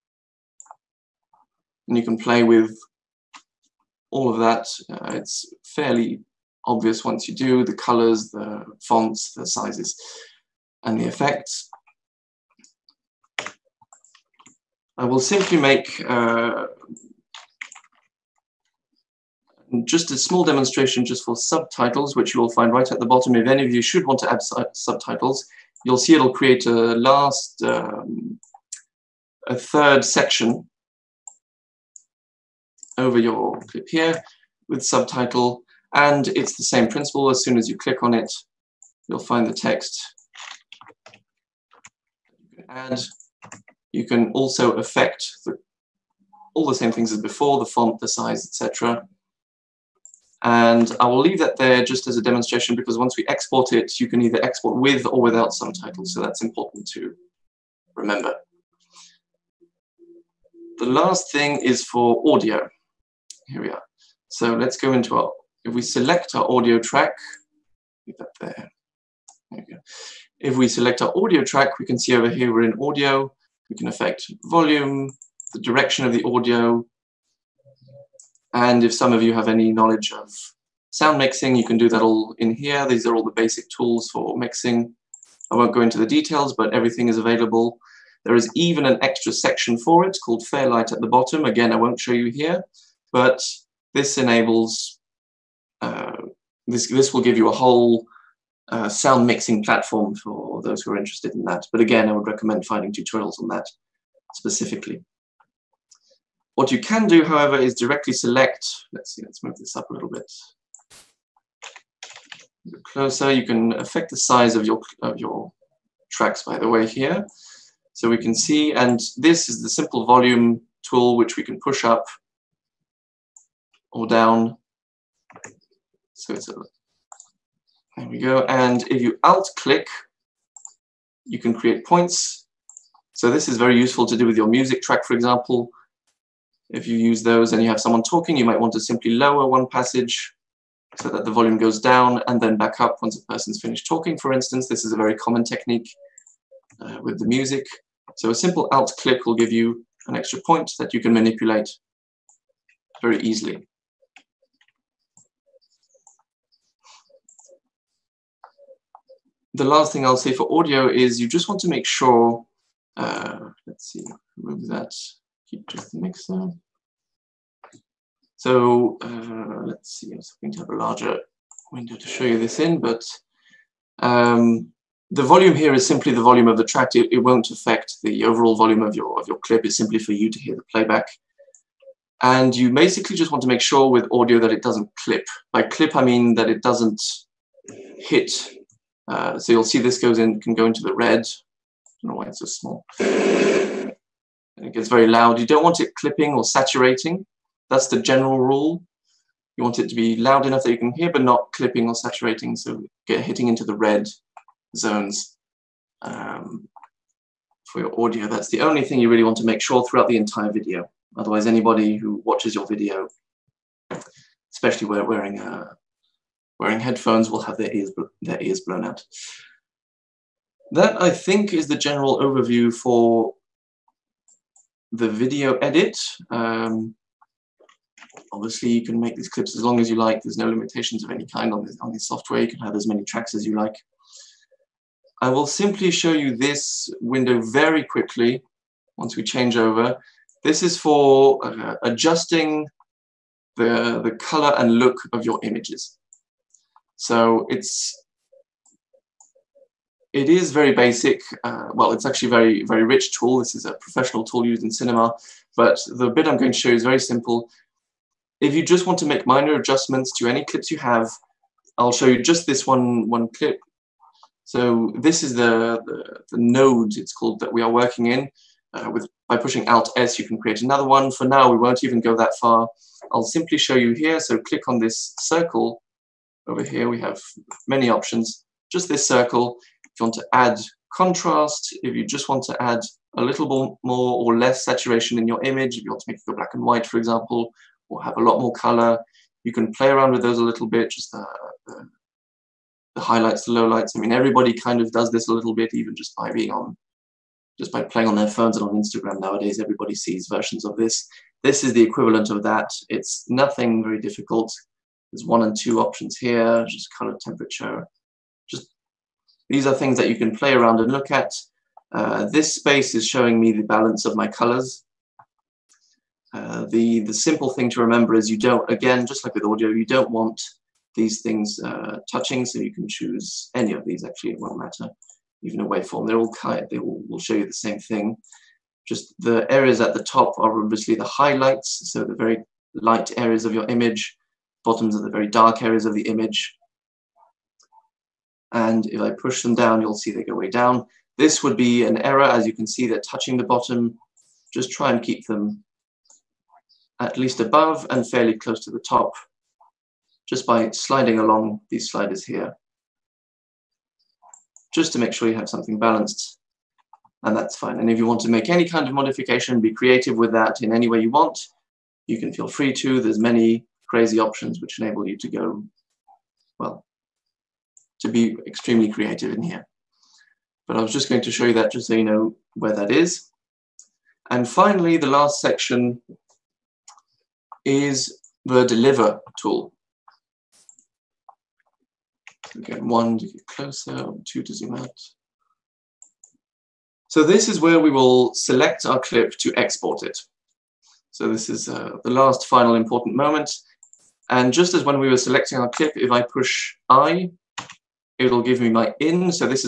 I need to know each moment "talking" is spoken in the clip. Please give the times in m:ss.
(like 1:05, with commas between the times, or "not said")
2:18, 2:23.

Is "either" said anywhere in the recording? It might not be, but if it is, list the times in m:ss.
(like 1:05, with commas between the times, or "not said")
0:54.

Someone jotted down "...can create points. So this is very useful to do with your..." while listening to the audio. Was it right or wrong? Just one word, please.
right.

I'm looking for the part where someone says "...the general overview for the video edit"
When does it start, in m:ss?
3:41.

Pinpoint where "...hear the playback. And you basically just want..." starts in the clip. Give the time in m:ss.
3:00.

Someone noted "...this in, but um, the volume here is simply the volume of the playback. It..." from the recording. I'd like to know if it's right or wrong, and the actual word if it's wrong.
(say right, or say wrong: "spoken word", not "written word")
wrong: "track", not "playback".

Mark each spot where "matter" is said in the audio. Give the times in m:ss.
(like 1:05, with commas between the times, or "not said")
5:24.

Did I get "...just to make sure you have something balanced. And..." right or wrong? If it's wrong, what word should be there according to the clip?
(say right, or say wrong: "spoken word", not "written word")
right.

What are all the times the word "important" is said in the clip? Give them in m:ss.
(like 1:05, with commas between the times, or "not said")
0:56, 6:32.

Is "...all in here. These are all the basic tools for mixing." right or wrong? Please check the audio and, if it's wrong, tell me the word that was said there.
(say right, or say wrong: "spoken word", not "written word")
right.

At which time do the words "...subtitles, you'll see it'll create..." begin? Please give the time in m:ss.
0:24.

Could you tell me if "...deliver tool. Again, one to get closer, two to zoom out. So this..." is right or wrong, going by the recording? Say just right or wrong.
right.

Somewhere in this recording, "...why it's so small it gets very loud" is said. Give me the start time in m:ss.
3:12.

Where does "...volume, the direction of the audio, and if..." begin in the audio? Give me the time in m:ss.
1:14.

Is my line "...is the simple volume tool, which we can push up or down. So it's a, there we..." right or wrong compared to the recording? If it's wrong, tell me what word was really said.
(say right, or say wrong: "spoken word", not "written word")
right.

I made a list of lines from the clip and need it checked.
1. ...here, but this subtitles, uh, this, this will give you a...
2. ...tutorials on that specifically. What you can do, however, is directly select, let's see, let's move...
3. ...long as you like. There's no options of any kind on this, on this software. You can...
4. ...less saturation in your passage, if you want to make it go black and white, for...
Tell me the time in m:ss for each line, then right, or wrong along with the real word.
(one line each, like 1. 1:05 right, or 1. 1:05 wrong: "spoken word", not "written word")
1. 1:32 wrong: "enables", not "subtitles"
2. 1:42 right
3. 3:49 wrong: "limitations", not "options"
4. 4:44 wrong: "image", not "passage".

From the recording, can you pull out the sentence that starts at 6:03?
There's many crazy options which enable you to go, well, to be extremely creative in here.